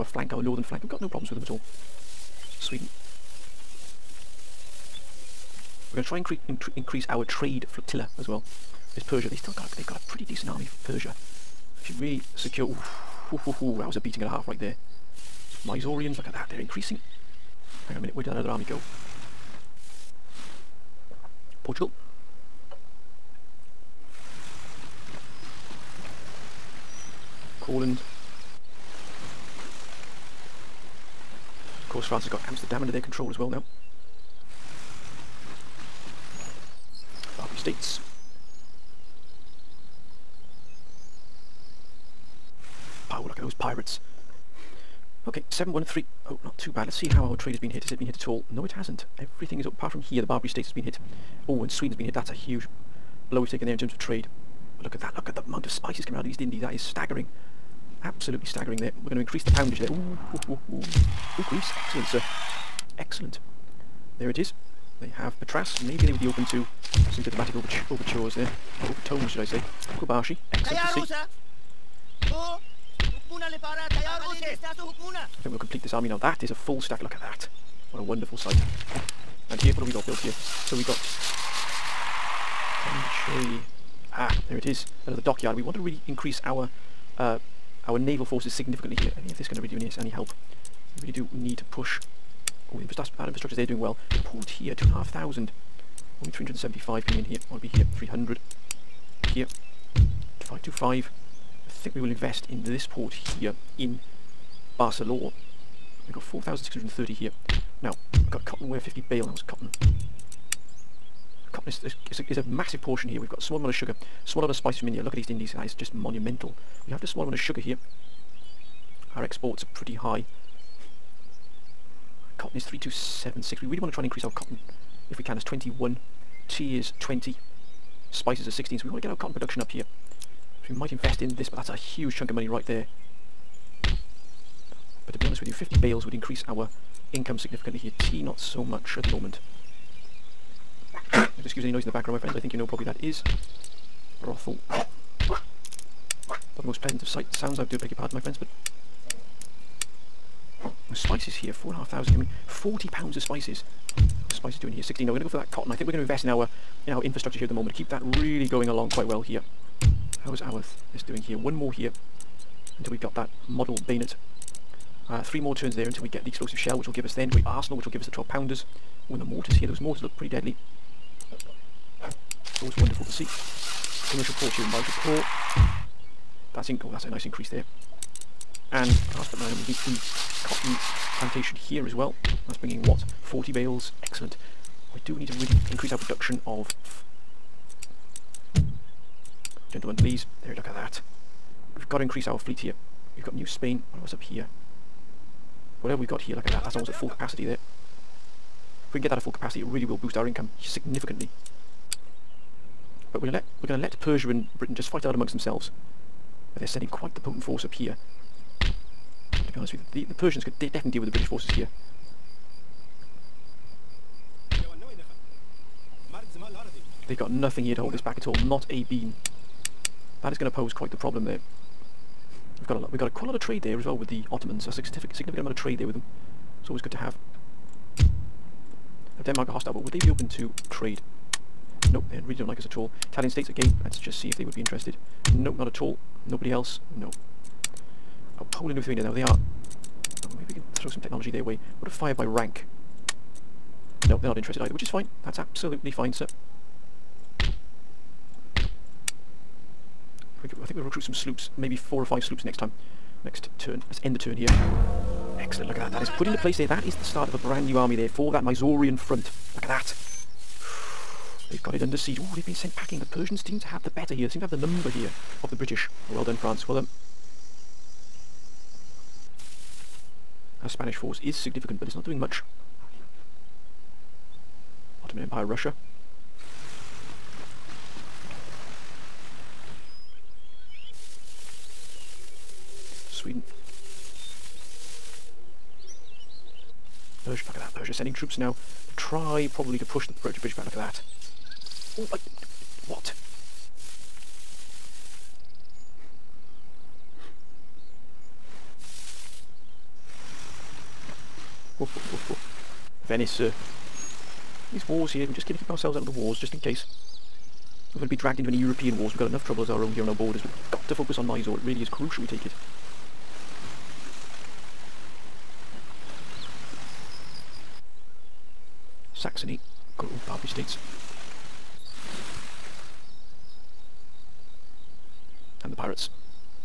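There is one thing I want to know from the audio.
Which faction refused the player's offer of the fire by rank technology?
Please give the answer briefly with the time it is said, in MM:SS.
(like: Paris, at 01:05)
Poland and Lithuania, at 03:58.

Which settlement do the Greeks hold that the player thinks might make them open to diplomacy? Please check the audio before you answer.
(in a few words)
Patras.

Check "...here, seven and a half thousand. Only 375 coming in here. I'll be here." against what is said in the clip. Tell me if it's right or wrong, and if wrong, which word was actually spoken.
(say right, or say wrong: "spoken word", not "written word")
wrong: "two", not "seven".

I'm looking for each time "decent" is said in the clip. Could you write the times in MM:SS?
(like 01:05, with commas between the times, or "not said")
00:10.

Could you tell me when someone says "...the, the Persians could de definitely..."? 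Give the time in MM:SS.
03:30.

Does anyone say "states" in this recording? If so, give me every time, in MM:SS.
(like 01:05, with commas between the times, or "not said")
00:37, 00:50, 03:53, 05:20.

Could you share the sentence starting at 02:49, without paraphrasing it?
When the mortars here, those mortars look pretty deadly.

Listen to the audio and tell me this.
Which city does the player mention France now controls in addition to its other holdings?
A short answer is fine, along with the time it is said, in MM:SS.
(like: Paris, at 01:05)
Amsterdam, at 00:32.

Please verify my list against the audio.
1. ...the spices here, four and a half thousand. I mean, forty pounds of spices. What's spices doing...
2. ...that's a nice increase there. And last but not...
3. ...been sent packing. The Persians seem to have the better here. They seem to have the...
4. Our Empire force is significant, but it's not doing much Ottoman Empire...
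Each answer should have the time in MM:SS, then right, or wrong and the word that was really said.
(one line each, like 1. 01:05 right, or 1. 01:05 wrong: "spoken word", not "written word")
1. 02:30 right
2. 02:56 right
3. 04:22 right
4. 04:30 wrong: "Spanish", not "Empire".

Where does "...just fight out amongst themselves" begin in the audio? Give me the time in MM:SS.
03:24.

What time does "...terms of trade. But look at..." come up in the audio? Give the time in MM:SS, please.
00:53.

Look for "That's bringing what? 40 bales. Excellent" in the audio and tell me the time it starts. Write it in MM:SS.
03:02.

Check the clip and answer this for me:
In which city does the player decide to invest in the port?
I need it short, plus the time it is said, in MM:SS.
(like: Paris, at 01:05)
Barcelona, at 01:44.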